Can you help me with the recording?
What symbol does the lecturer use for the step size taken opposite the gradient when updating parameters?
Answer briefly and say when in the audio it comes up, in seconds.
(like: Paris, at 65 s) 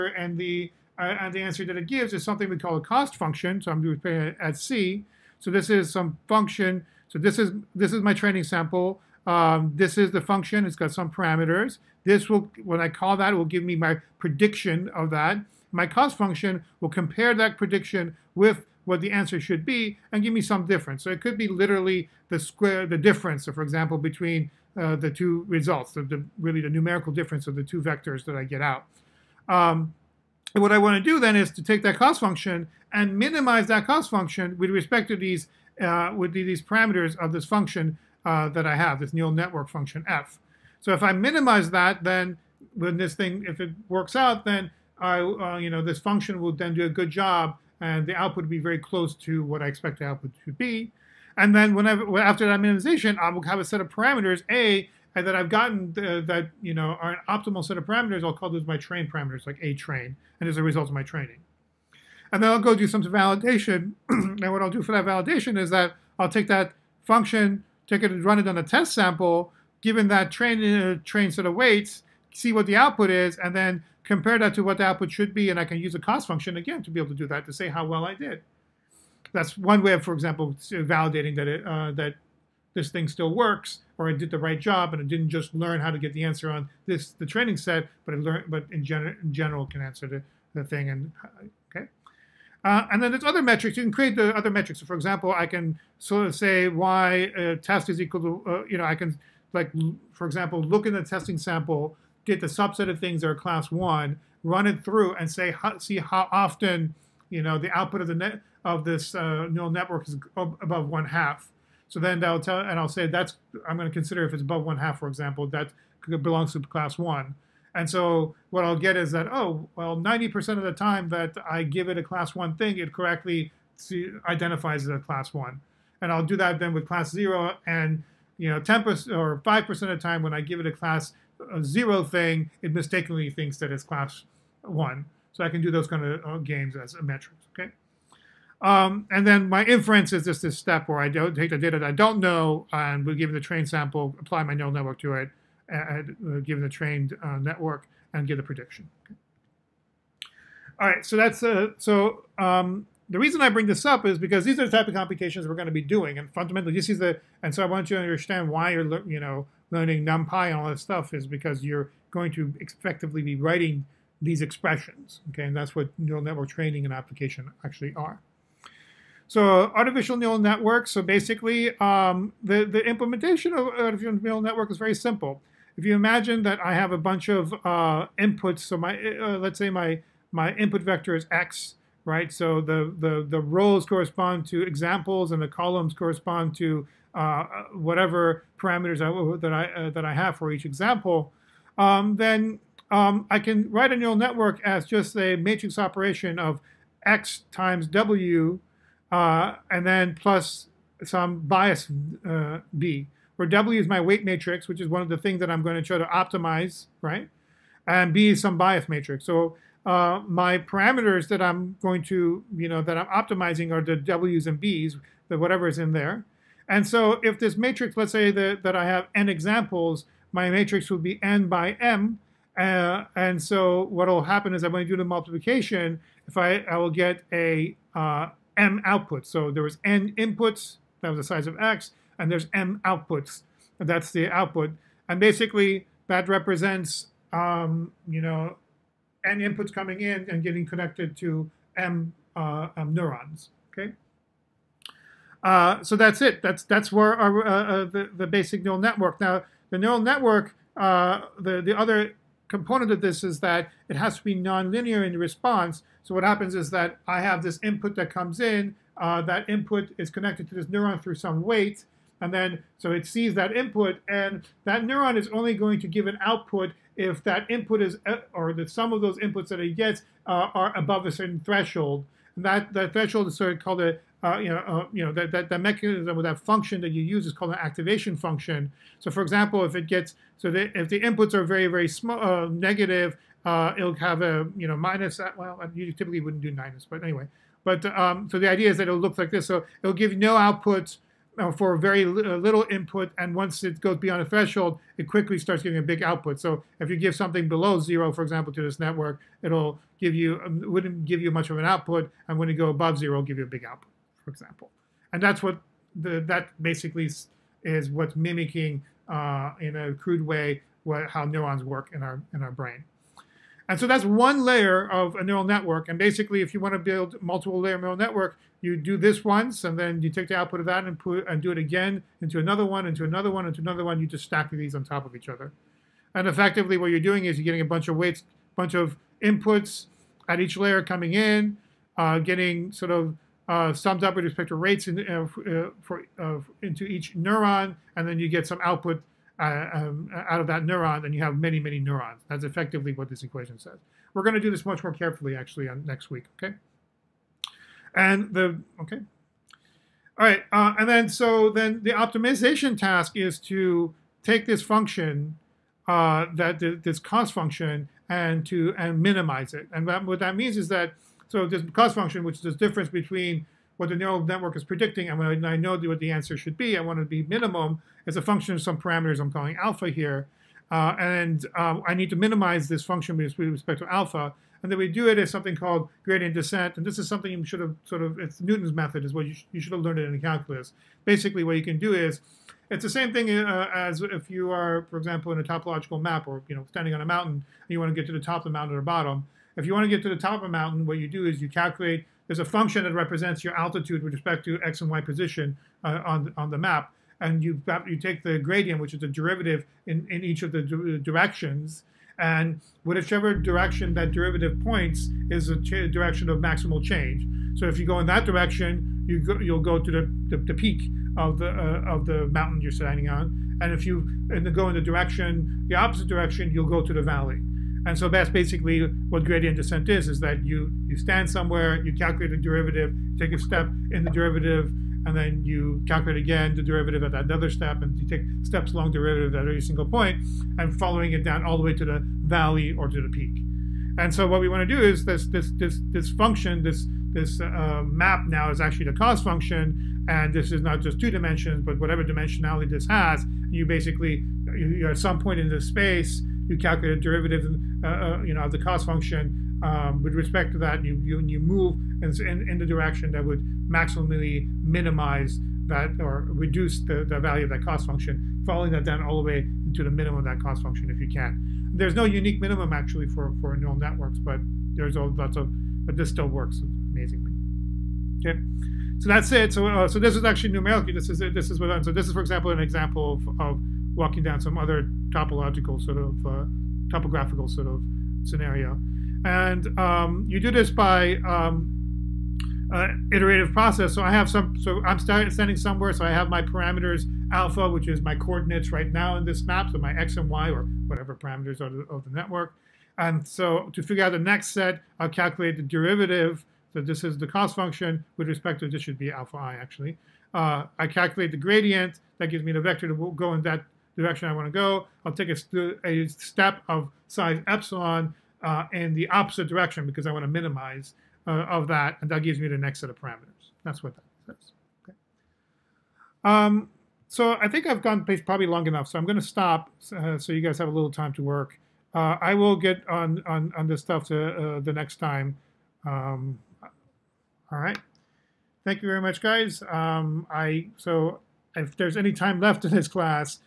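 epsilon, at 507 s.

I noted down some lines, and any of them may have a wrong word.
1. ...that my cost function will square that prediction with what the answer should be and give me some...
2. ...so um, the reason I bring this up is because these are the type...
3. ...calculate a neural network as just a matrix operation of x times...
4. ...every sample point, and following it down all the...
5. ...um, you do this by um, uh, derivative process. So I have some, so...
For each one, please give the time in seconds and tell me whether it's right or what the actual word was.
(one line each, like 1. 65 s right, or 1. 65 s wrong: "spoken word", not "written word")
1. 15 s wrong: "compare", not "square"
2. 151 s right
3. 193 s wrong: "write", not "calculate"
4. 429 s wrong: "single", not "sample"
5. 479 s wrong: "iterative", not "derivative".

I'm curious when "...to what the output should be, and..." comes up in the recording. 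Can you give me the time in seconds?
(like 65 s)
74 s.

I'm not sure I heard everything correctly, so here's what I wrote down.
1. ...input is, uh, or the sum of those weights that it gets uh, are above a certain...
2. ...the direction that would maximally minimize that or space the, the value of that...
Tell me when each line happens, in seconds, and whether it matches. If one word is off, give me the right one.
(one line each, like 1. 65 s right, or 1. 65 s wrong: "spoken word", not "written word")
1. 267 s wrong: "inputs", not "weights"
2. 452 s wrong: "reduce", not "space".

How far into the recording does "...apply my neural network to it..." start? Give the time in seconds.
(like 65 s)
144 s.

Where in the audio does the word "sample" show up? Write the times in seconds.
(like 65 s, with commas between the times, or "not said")
8 s, 68 s, 101 s, 143 s.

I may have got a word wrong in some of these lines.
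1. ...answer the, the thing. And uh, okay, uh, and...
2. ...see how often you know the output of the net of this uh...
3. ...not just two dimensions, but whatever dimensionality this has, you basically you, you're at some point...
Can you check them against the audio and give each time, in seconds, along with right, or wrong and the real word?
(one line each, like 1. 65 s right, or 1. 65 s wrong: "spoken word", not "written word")
1. 89 s right
2. 105 s right
3. 440 s right.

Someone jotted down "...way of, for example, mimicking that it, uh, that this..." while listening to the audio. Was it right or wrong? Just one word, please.
wrong.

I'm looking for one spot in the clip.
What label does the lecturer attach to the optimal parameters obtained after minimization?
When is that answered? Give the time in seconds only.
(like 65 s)
59 s.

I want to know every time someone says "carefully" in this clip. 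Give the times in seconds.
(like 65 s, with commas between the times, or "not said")
344 s.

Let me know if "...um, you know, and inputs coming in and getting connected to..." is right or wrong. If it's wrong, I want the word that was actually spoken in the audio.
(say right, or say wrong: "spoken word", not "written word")
right.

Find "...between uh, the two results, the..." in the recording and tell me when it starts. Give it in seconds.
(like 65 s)
23 s.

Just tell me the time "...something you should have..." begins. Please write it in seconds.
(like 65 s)
377 s.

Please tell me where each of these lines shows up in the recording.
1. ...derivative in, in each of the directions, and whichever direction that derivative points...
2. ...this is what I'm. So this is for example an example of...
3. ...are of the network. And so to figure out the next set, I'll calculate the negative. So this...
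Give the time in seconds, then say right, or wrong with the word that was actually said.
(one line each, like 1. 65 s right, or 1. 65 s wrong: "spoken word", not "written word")
1. 399 s right
2. 471 s right
3. 491 s wrong: "derivative", not "negative".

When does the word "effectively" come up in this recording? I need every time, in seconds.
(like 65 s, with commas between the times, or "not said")
162 s, 326 s, 342 s.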